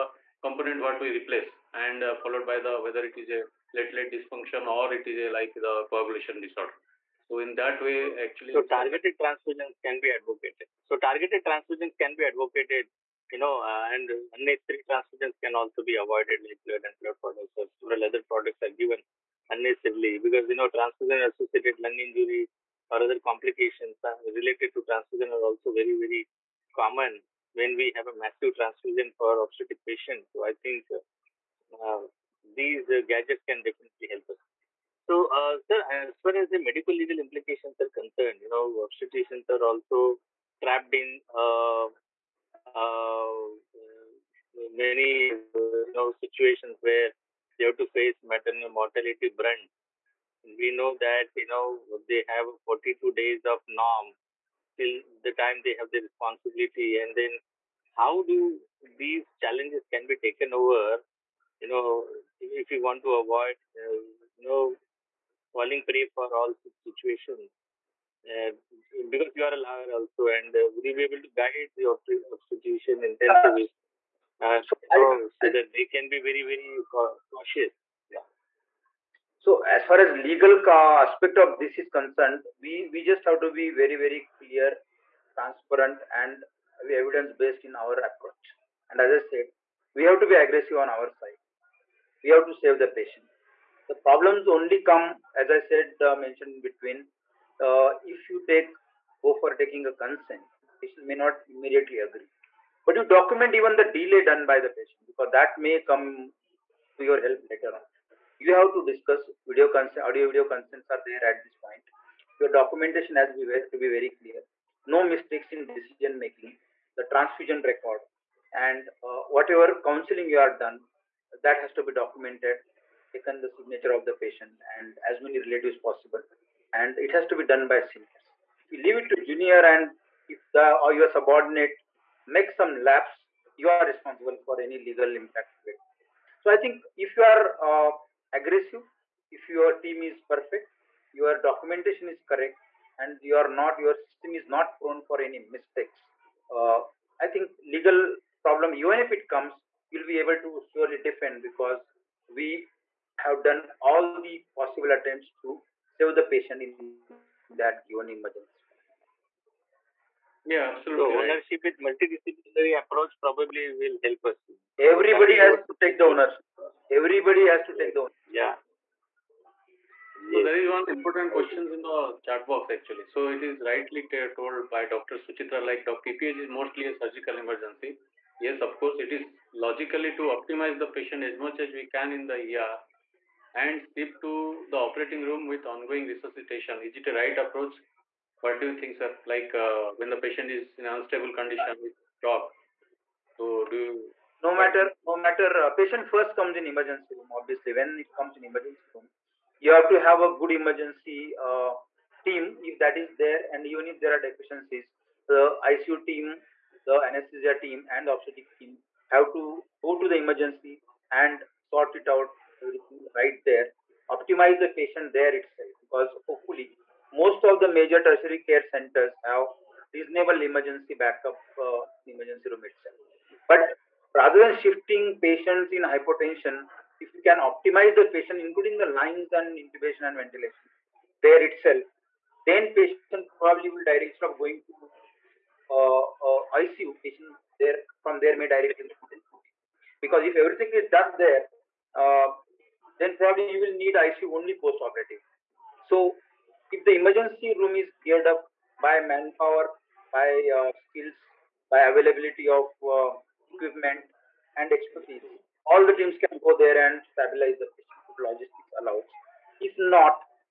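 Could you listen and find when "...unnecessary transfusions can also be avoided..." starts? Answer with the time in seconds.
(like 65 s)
14 s.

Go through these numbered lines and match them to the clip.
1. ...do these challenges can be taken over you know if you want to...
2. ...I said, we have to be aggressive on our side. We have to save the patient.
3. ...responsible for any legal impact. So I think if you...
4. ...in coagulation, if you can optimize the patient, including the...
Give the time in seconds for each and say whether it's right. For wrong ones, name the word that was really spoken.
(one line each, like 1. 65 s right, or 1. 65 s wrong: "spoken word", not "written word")
1. 58 s right
2. 89 s right
3. 133 s right
4. 225 s wrong: "hypotension", not "coagulation".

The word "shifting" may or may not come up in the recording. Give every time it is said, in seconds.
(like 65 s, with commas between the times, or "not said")
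224 s.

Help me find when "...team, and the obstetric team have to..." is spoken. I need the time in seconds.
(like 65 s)
207 s.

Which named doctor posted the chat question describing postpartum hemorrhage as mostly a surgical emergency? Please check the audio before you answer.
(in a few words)
Dr. Suchitra.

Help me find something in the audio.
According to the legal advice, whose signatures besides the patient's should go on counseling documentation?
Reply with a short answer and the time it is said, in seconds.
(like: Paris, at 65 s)
as many relatives possible, at 125 s.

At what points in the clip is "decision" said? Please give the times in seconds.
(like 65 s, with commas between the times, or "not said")
115 s.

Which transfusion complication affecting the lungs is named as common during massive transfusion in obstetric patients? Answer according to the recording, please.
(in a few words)
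transfusion associated lung injury.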